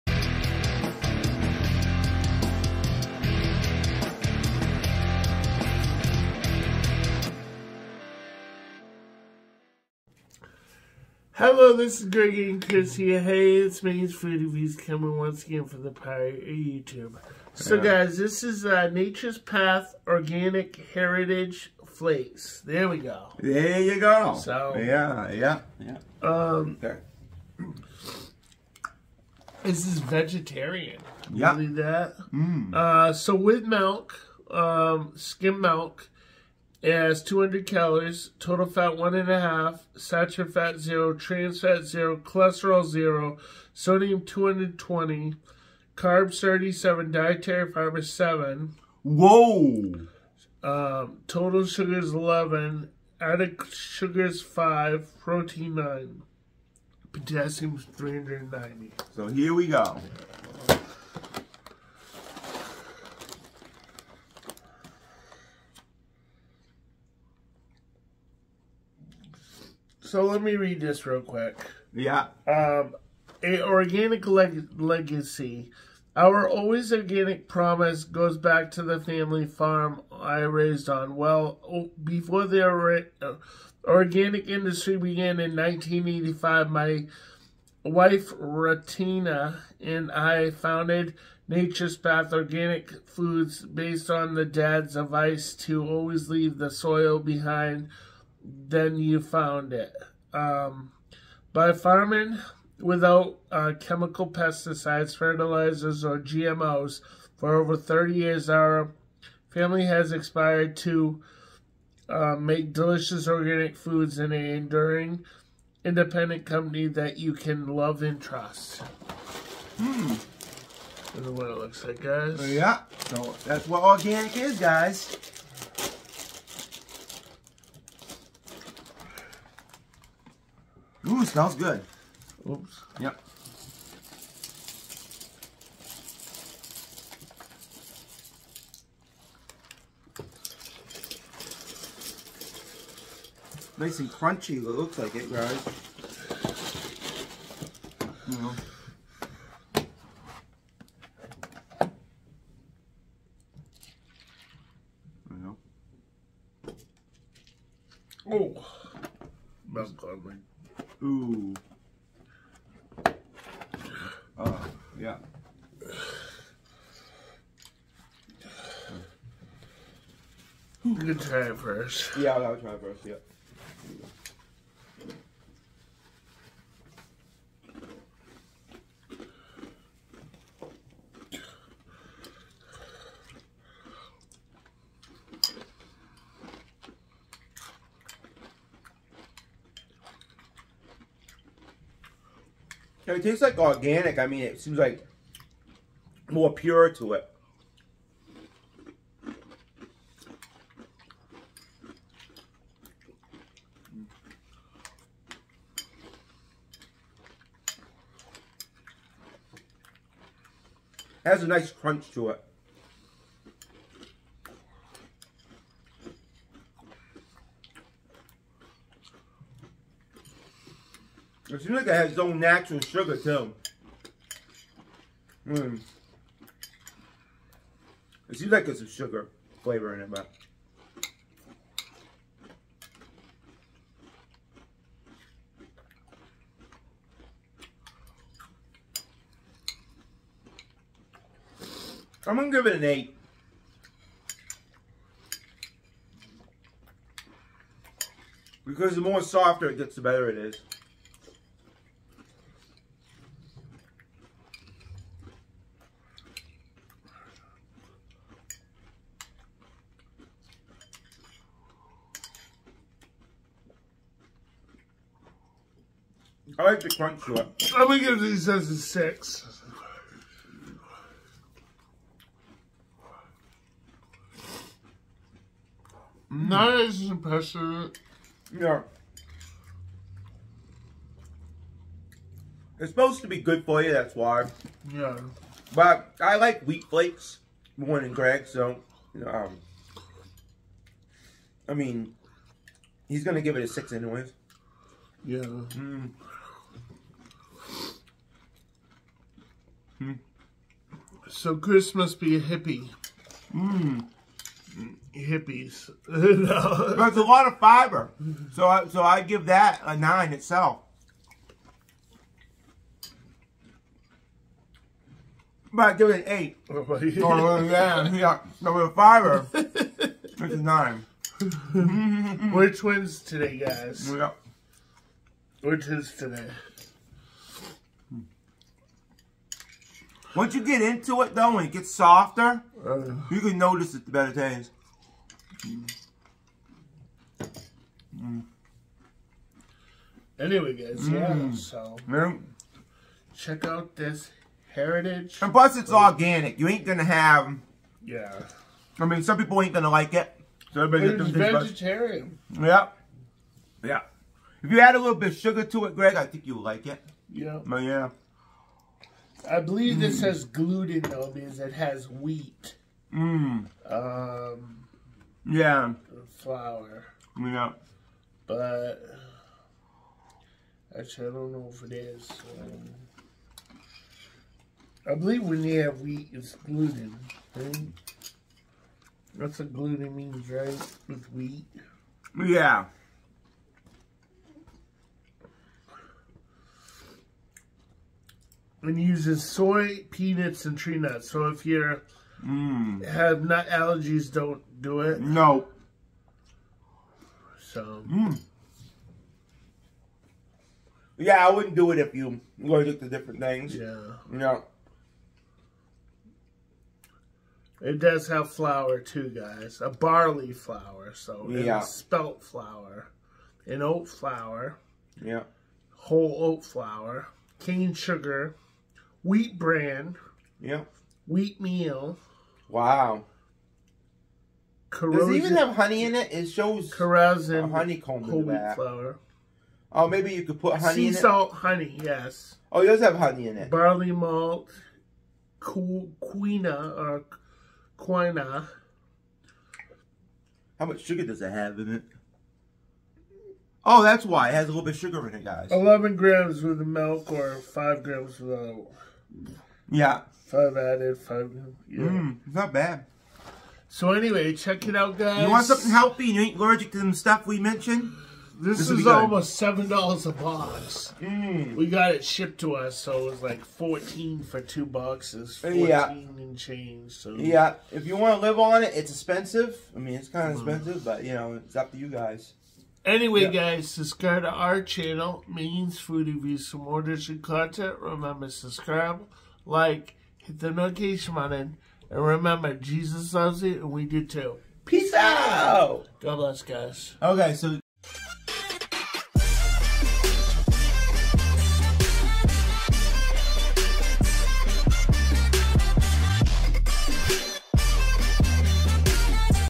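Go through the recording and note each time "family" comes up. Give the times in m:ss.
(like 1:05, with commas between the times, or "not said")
1:18, 1:49.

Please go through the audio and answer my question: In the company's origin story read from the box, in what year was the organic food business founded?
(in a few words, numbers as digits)
1985.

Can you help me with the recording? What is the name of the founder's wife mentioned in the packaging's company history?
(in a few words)
Ratana.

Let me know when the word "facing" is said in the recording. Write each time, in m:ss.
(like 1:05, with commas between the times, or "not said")
not said.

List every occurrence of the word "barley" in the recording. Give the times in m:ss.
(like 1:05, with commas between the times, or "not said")
6:49, 7:13.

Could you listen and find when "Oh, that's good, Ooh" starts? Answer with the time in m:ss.
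2:38.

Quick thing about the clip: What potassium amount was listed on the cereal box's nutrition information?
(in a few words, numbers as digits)
390.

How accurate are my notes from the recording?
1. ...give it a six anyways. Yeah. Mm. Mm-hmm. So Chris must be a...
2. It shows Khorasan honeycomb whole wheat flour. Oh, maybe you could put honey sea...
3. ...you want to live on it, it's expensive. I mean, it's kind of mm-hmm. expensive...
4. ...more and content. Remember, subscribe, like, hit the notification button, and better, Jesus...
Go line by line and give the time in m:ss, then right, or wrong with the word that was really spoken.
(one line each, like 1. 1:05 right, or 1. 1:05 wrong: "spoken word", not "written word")
1. 4:53 right
2. 7:06 right
3. 7:48 right
4. 7:56 wrong: "remember", not "better".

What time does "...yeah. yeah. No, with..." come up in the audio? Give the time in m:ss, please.
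5:17.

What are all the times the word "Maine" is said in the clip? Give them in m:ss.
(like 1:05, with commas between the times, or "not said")
0:13, 7:55.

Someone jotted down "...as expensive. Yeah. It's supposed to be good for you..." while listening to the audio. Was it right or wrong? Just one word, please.
wrong.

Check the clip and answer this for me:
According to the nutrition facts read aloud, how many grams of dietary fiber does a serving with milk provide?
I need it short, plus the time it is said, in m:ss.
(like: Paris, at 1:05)
7, at 0:47.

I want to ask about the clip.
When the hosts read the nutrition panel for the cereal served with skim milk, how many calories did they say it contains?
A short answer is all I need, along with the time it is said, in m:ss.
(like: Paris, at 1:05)
200, at 0:37.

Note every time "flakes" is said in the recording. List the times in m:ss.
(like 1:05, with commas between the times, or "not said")
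0:21, 4:46.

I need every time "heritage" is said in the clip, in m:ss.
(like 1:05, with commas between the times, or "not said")
0:20, 5:44.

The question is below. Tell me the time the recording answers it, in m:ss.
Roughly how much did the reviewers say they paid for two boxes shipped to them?
7:43.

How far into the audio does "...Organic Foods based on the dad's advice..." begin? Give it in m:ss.
1:32.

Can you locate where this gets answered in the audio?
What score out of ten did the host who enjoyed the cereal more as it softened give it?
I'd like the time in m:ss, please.
4:02.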